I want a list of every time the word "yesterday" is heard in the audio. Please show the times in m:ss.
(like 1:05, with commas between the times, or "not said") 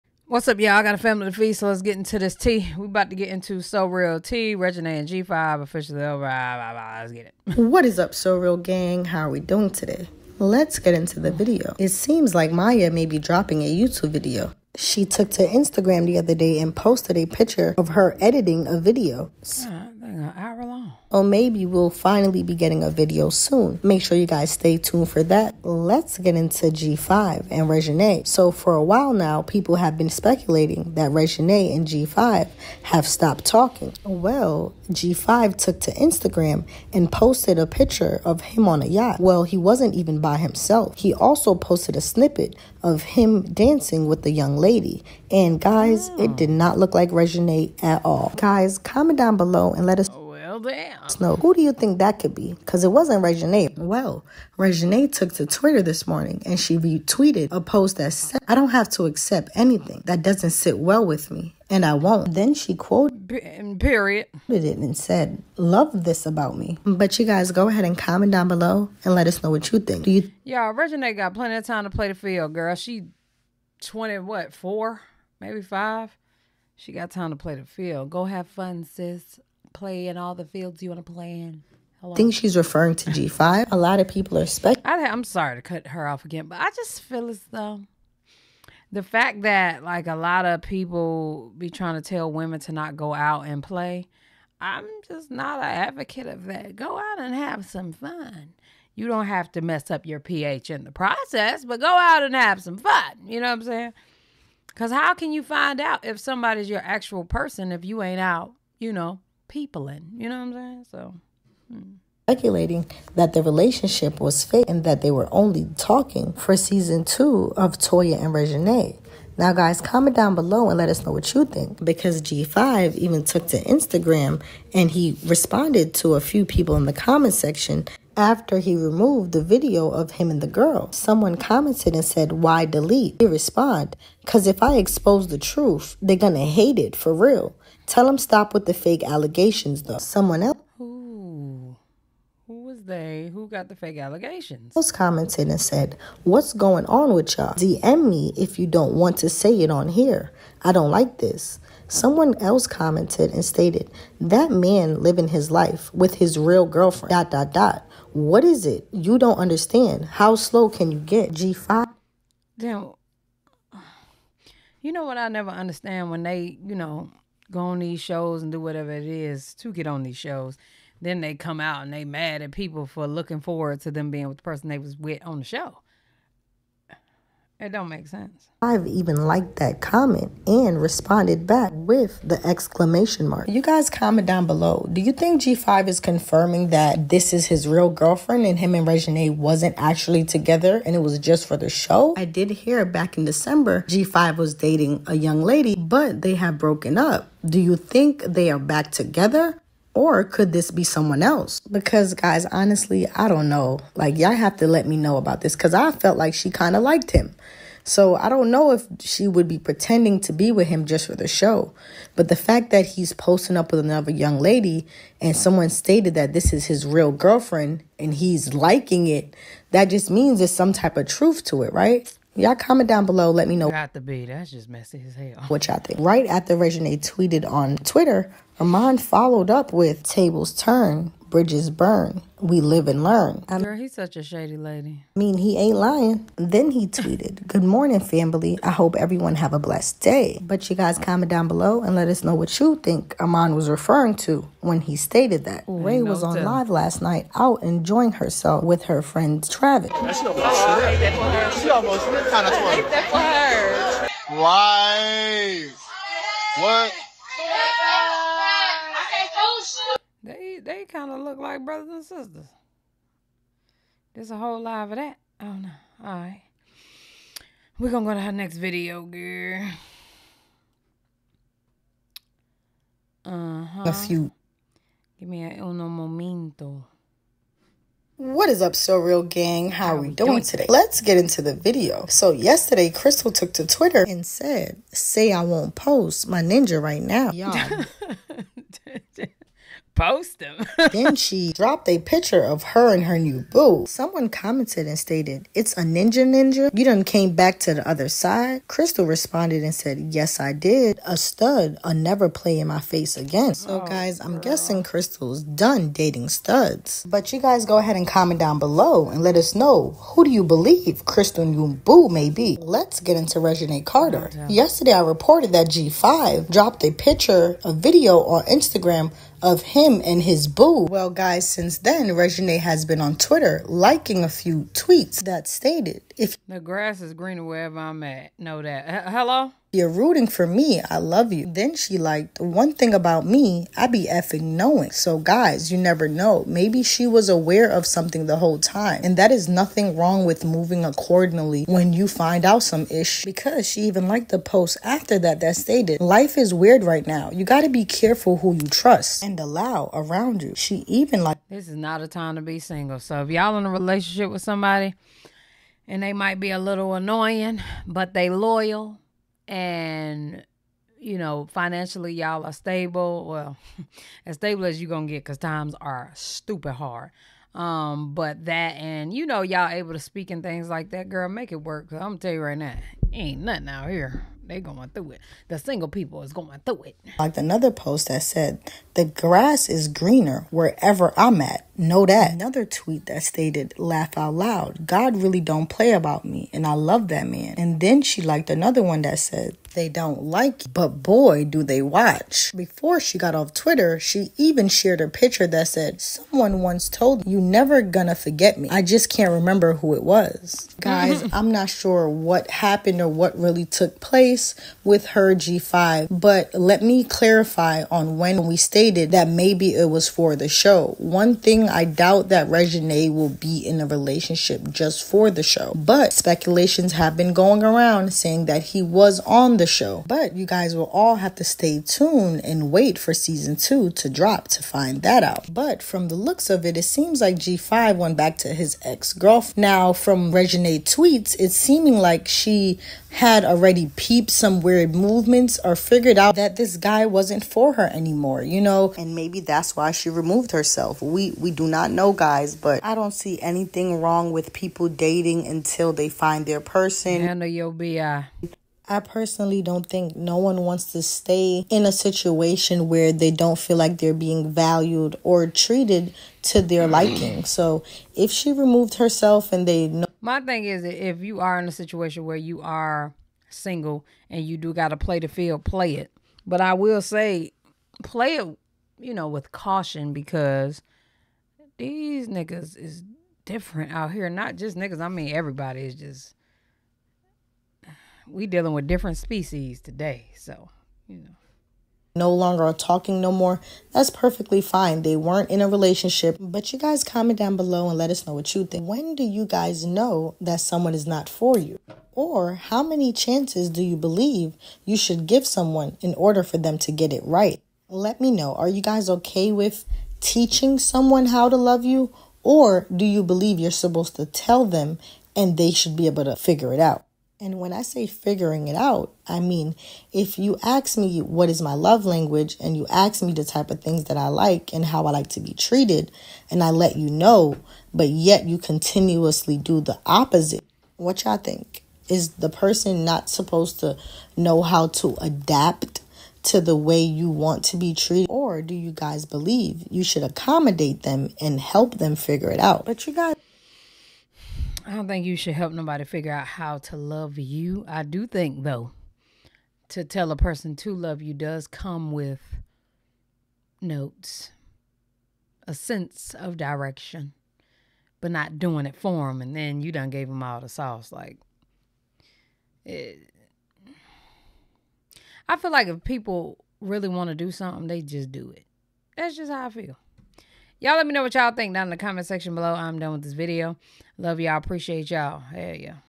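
4:42, 5:14.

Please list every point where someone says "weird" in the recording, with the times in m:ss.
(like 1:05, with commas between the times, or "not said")
5:46, 7:14.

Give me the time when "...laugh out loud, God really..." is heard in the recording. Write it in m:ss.
6:23.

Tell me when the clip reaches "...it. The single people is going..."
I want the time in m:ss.
6:15.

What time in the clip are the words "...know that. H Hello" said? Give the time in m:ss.
5:28.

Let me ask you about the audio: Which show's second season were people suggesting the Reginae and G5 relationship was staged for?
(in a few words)
Toya and Reginae.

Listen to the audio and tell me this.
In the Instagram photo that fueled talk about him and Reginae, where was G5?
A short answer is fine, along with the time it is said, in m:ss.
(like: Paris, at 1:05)
On a yacht, at 0:38.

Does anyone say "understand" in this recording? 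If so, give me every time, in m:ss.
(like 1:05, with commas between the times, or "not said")
2:39, 2:45.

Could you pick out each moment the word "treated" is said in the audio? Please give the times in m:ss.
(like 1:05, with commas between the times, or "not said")
7:35, 8:35, 8:47.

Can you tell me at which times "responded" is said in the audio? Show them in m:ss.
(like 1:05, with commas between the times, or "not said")
2:05, 2:13, 3:00, 4:59.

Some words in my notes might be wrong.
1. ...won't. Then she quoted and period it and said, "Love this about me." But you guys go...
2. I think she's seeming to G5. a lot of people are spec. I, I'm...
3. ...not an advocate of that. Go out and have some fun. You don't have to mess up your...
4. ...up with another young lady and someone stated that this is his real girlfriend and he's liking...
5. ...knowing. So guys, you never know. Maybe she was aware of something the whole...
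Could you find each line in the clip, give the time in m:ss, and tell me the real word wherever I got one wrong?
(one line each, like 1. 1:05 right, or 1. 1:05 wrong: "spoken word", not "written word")
1. 1:01 right
2. 1:22 wrong: "referring", not "seeming"
3. 1:35 right
4. 3:33 right
5. 5:34 right.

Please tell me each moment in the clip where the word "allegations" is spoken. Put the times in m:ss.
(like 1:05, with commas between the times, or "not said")
2:19, 2:23.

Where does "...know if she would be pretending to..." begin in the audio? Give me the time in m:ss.
3:28.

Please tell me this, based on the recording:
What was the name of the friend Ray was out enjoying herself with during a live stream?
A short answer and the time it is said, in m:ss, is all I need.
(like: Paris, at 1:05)
Travis, at 4:09.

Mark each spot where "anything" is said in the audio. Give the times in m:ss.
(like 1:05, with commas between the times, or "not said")
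0:59, 7:23.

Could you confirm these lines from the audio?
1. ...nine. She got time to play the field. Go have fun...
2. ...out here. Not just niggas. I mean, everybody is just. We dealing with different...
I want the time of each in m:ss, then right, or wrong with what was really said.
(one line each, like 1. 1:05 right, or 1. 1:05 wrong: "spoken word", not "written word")
1. 1:15 wrong: "five", not "nine"
2. 7:53 right.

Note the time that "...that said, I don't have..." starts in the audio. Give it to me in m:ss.
0:57.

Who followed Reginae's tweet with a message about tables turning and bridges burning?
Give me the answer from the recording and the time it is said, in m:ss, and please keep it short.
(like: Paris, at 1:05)
Armand, at 3:48.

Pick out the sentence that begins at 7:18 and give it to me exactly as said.
And maybe that's why she removed herself.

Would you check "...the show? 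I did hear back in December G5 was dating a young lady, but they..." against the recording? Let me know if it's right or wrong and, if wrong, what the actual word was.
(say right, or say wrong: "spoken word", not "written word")
right.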